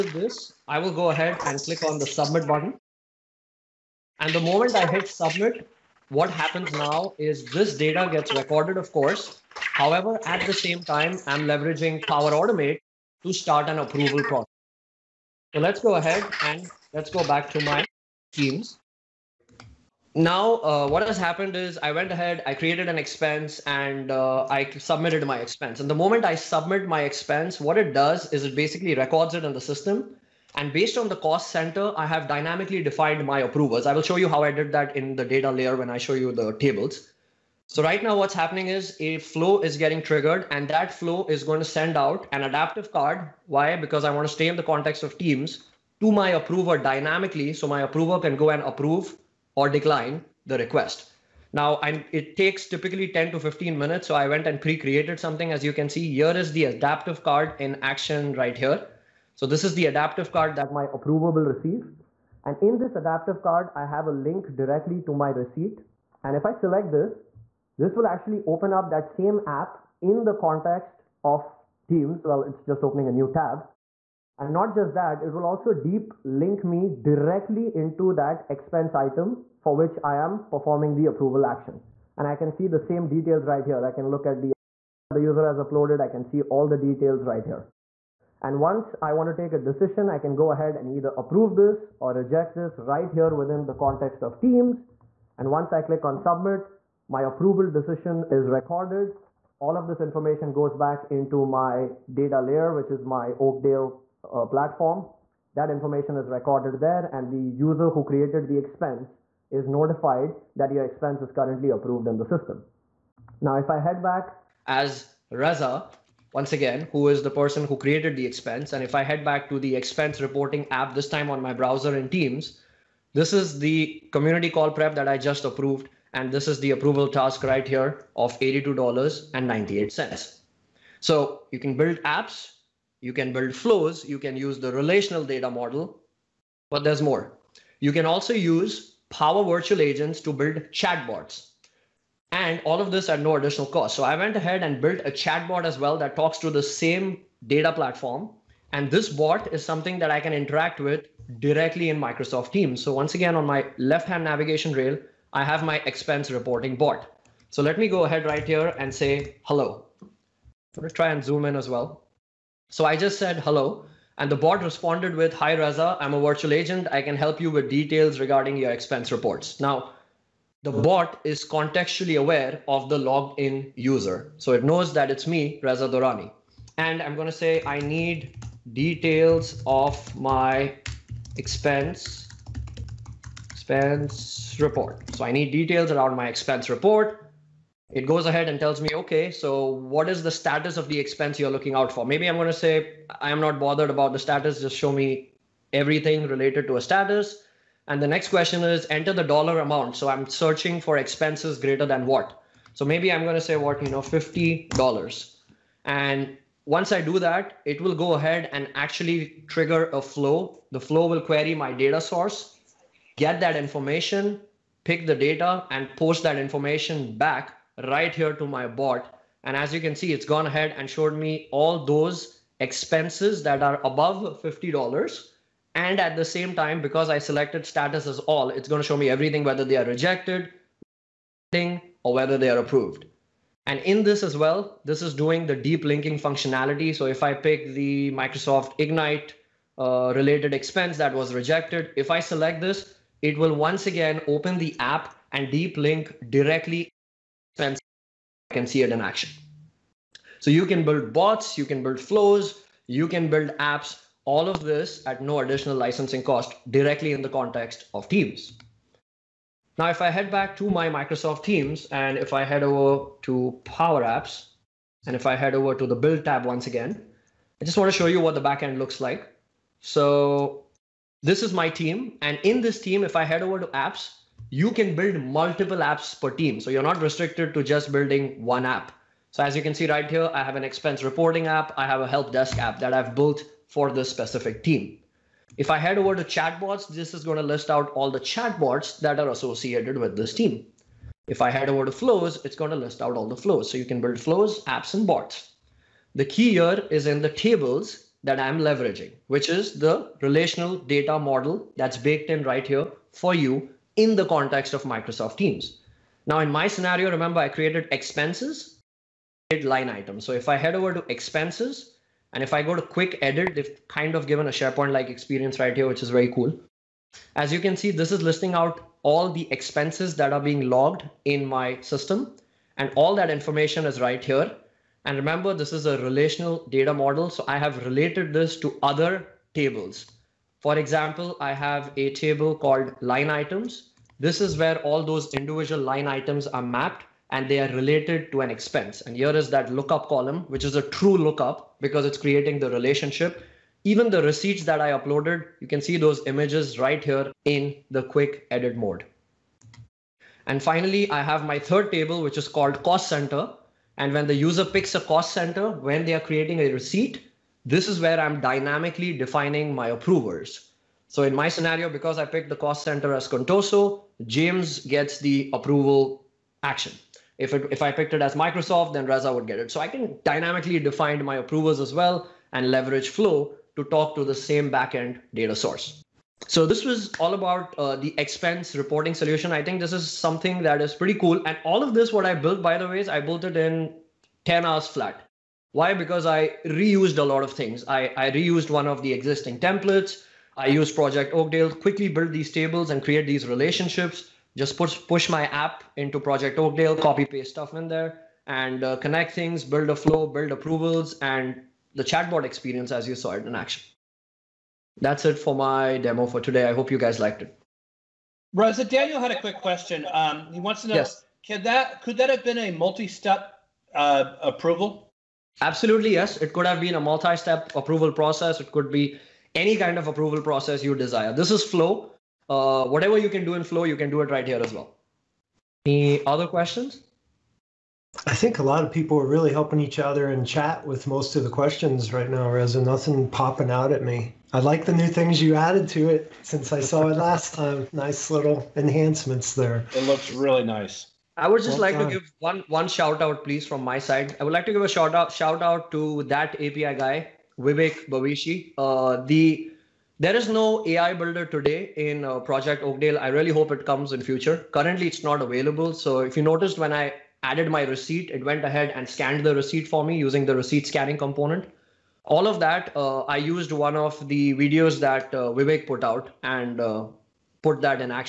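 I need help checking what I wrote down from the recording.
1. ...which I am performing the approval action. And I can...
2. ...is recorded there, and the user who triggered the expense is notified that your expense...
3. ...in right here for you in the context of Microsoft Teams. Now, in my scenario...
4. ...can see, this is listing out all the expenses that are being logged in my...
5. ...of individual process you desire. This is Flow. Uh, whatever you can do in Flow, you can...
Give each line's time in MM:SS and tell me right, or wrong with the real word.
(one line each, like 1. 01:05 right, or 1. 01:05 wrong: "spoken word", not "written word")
1. 01:19 right
2. 01:46 wrong: "created", not "triggered"
3. 05:02 right
4. 05:17 right
5. 06:59 wrong: "approval", not "individual".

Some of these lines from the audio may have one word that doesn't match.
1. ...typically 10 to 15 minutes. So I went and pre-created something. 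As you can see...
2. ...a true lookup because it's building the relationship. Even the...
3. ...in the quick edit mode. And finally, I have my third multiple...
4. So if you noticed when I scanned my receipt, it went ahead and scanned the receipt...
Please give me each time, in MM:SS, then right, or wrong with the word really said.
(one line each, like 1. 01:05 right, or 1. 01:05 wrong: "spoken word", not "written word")
1. 00:52 right
2. 05:40 wrong: "creating", not "building"
3. 05:47 wrong: "table", not "multiple"
4. 07:35 wrong: "added", not "scanned".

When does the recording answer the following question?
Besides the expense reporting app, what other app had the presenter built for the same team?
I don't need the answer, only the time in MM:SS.
04:42.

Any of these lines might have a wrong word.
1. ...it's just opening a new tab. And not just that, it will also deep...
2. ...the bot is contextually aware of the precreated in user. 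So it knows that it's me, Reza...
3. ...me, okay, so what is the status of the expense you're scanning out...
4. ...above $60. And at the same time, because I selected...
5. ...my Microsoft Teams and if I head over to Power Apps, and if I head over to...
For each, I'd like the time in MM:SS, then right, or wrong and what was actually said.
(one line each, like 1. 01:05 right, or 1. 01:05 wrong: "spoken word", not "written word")
1. 01:12 right
2. 02:50 wrong: "logged", not "precreated"
3. 03:08 wrong: "looking", not "scanning"
4. 03:43 wrong: "50", not "60"
5. 04:20 right.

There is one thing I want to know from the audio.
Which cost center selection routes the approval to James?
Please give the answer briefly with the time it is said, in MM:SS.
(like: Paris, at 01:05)
Contoso, at 06:03.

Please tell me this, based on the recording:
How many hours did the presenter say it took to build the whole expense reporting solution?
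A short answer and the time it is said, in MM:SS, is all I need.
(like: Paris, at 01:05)
10, at 06:24.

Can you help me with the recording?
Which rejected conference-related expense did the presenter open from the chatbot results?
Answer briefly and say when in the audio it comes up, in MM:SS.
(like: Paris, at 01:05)
Microsoft Ignite, at 03:58.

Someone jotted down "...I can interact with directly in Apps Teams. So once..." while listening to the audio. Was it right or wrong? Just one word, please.
wrong.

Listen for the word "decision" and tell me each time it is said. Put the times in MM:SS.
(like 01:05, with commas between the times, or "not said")
01:29, 01:37.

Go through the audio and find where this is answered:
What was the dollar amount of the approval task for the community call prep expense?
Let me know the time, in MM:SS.
02:08.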